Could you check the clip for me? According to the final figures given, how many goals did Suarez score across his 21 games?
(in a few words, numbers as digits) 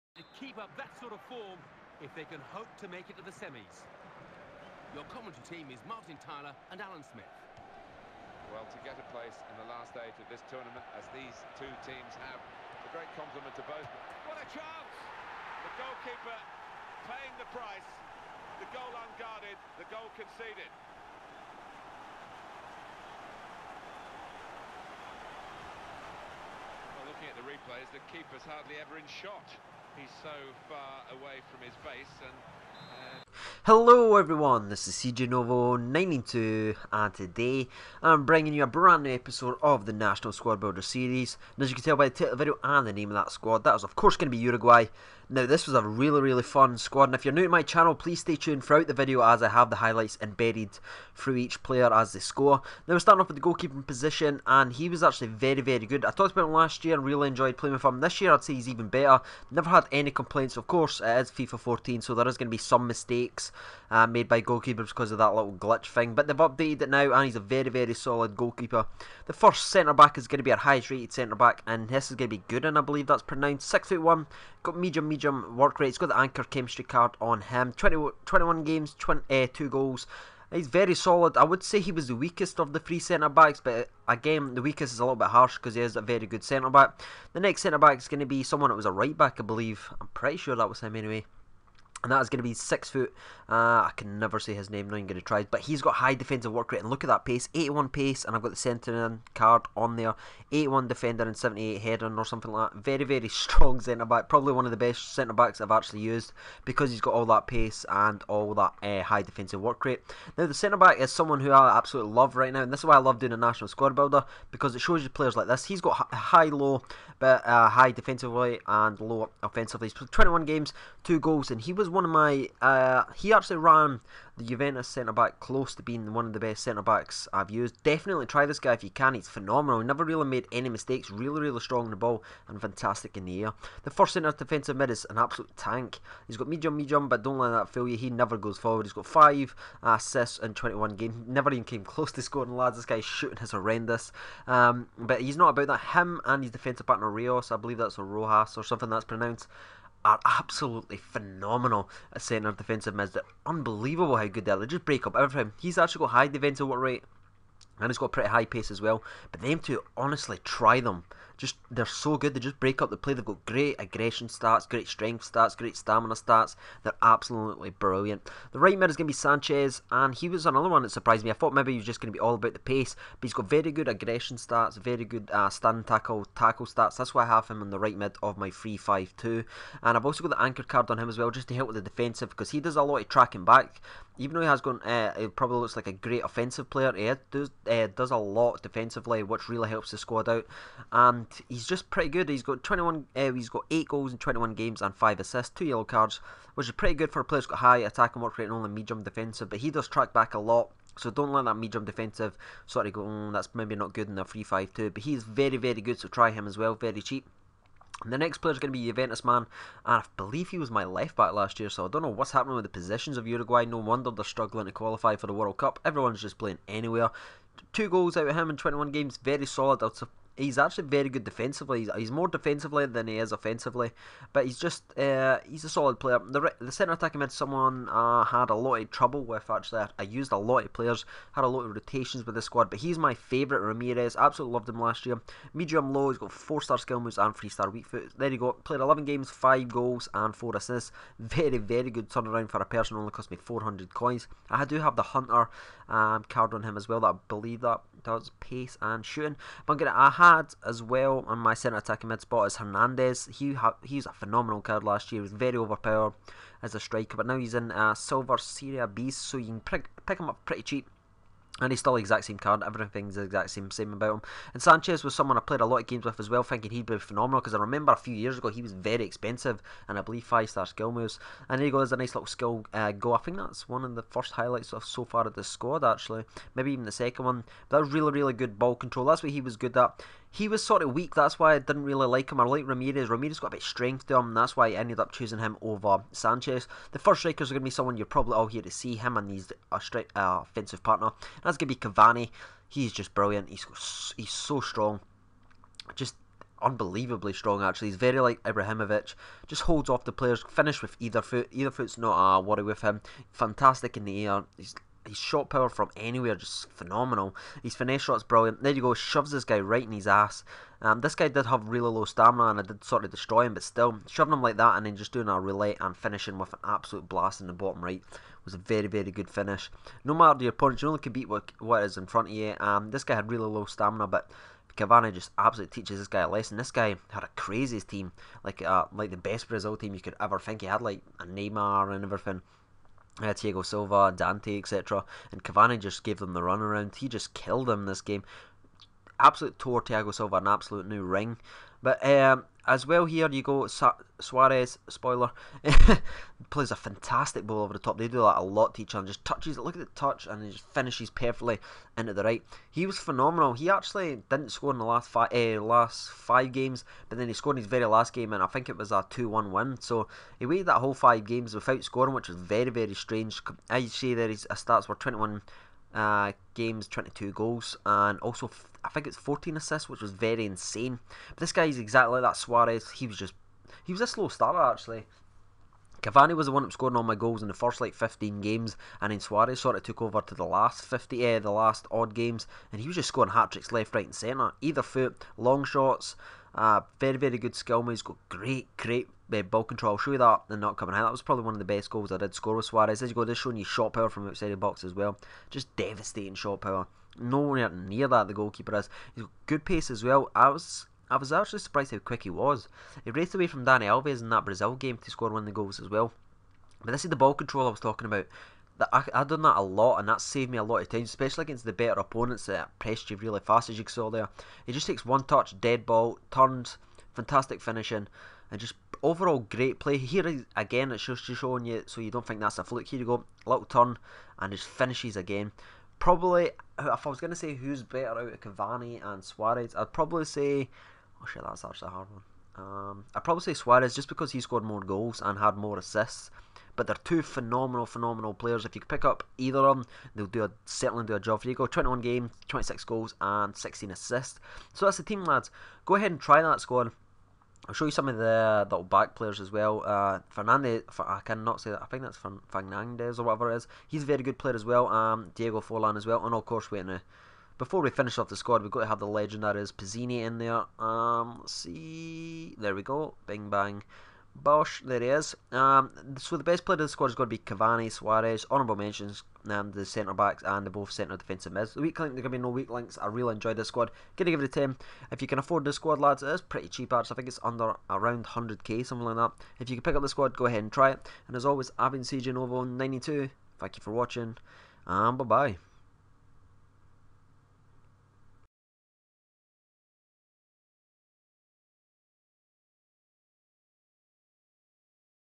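26.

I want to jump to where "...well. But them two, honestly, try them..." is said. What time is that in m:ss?
2:38.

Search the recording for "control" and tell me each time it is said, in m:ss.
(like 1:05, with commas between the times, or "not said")
4:38, 6:29, 6:47.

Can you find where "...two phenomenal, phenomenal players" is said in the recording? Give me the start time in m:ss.
7:17.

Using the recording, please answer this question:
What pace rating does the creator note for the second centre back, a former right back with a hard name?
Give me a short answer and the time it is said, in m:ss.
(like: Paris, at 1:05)
81, at 1:37.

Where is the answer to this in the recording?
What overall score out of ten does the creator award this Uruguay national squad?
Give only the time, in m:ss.
7:54.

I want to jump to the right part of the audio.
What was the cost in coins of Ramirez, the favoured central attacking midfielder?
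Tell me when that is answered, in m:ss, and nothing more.
4:03.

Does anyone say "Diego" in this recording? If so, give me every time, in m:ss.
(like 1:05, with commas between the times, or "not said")
5:33, 7:35.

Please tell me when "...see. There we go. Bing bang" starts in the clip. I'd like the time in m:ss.
7:41.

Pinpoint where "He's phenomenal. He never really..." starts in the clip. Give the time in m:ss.
2:09.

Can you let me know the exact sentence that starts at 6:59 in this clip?
Here again, it's just showing you so you don't think that's a fluke.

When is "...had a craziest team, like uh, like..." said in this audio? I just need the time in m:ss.
5:27.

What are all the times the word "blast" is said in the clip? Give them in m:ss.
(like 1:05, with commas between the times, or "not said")
5:17.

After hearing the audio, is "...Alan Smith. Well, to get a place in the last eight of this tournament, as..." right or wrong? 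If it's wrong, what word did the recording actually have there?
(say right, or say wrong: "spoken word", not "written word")
right.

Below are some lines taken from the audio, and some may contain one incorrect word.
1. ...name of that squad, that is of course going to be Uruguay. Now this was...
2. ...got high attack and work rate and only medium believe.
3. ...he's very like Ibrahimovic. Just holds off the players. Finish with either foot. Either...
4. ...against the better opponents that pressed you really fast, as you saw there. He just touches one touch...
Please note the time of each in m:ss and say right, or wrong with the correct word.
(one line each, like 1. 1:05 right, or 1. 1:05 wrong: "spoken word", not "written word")
1. 0:42 right
2. 3:17 wrong: "defensive", not "believe"
3. 4:57 right
4. 6:51 wrong: "takes", not "touches".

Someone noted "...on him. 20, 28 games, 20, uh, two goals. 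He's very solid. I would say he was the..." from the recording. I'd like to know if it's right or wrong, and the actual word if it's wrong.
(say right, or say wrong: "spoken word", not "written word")
wrong: "21", not "28".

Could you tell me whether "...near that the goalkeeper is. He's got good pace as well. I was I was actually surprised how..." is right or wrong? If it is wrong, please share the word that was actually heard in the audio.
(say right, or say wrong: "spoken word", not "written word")
right.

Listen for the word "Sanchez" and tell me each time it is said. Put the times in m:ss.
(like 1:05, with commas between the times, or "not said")
2:49, 4:24, 4:46.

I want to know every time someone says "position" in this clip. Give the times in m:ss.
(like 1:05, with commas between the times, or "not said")
0:53, 3:32.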